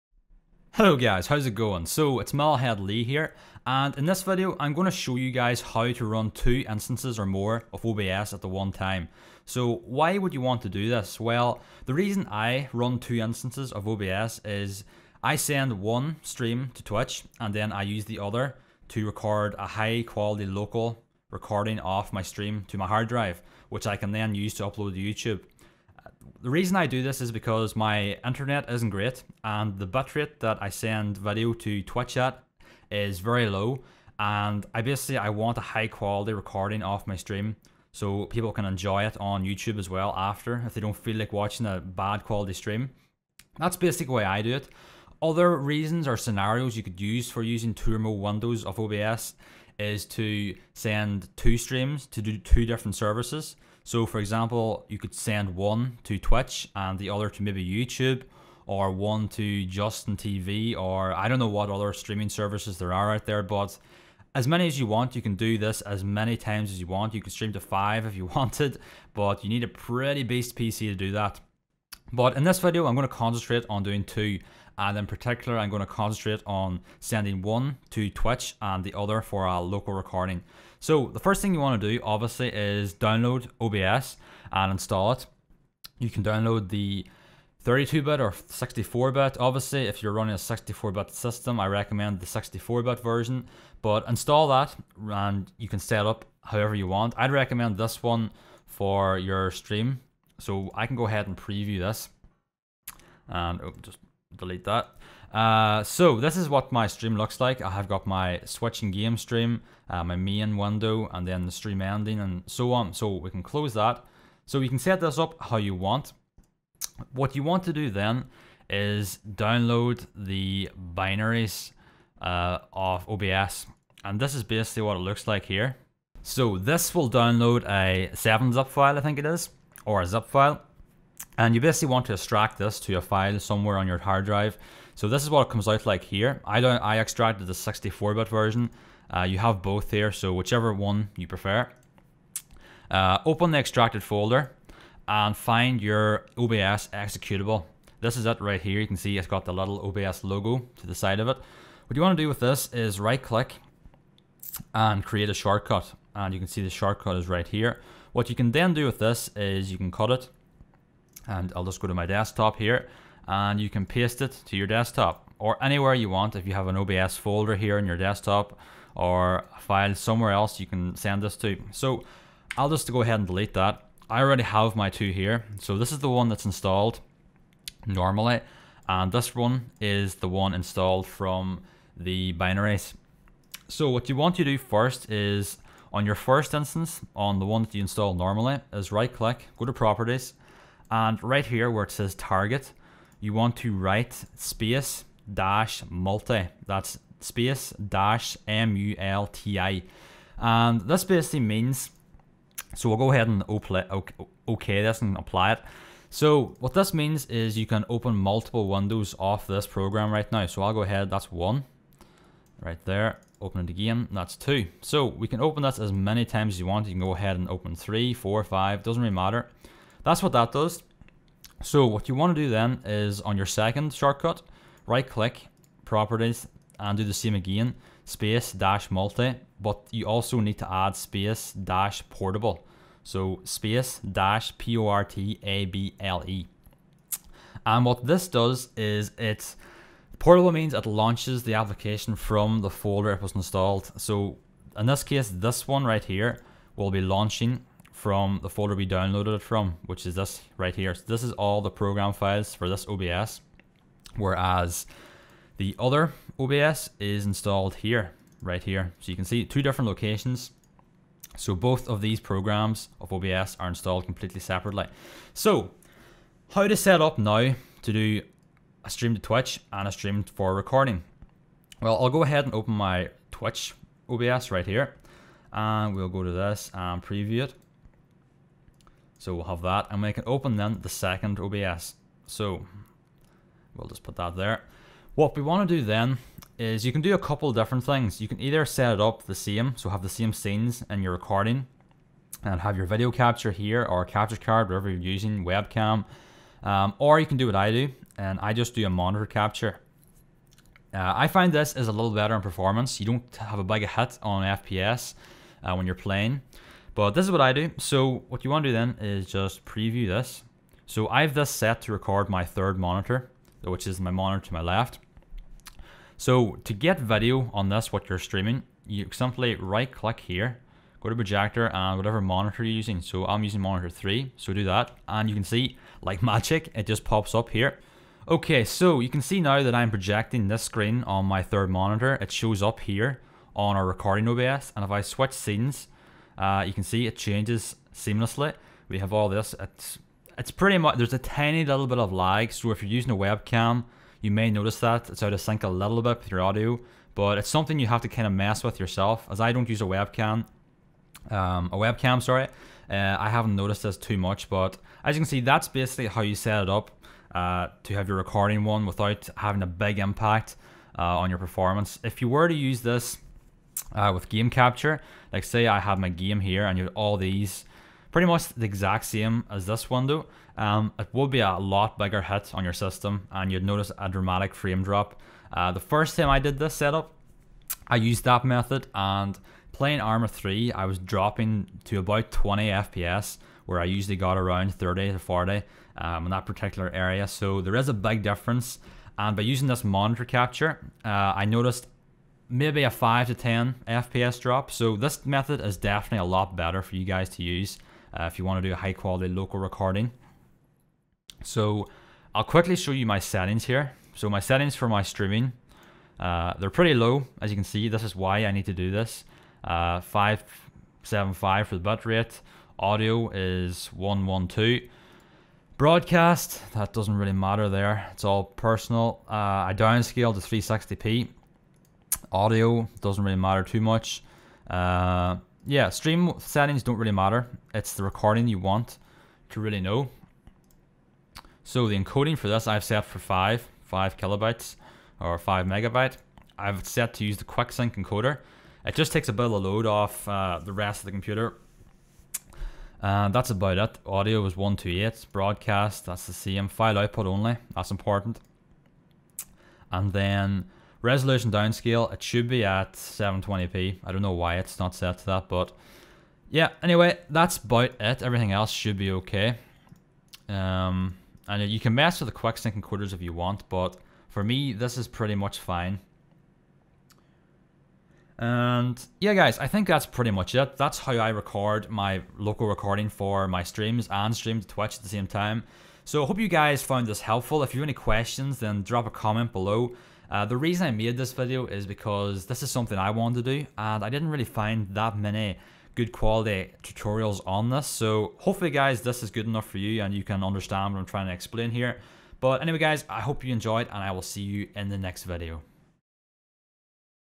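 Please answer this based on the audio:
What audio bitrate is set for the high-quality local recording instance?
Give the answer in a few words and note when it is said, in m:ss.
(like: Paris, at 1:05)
128, at 7:24.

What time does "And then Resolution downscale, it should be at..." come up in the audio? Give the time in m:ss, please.
7:29.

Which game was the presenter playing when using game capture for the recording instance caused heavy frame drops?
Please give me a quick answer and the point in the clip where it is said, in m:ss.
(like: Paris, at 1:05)
Arma 3, at 6:20.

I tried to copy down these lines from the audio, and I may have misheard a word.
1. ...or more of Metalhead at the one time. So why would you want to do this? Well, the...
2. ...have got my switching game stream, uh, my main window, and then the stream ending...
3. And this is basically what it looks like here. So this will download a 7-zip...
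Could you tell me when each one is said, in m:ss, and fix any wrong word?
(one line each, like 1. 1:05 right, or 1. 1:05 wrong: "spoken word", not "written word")
1. 0:07 wrong: "OBS", not "Metalhead"
2. 1:47 right
3. 2:04 right.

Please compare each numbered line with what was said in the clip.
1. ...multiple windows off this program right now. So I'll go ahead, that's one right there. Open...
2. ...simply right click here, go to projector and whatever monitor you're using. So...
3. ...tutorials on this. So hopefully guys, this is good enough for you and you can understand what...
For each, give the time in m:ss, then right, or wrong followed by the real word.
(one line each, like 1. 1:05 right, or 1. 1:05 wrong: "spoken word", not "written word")
1. 3:28 right
2. 5:19 right
3. 8:06 right.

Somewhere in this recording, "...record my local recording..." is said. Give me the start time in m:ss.
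7:51.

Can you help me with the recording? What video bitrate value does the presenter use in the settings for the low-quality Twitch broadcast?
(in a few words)
575.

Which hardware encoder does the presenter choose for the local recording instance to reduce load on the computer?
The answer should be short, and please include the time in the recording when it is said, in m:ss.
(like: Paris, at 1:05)
QuickSync, at 7:17.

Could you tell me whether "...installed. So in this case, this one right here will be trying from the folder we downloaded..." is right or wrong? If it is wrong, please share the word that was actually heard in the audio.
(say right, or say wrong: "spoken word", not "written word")
wrong: "launching", not "trying".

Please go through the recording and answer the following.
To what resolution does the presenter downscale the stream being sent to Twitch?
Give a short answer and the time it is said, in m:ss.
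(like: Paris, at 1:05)
360p, at 7:00.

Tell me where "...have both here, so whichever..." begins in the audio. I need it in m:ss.
2:19.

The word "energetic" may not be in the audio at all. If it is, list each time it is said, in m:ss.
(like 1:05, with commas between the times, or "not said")
not said.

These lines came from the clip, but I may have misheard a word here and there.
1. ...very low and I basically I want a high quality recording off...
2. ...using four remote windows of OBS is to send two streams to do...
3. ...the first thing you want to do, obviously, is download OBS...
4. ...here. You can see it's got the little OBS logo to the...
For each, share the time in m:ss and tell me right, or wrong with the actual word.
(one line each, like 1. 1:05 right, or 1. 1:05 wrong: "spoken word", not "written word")
1. 0:33 right
2. 0:47 wrong: "two", not "four"
3. 1:21 right
4. 2:28 right.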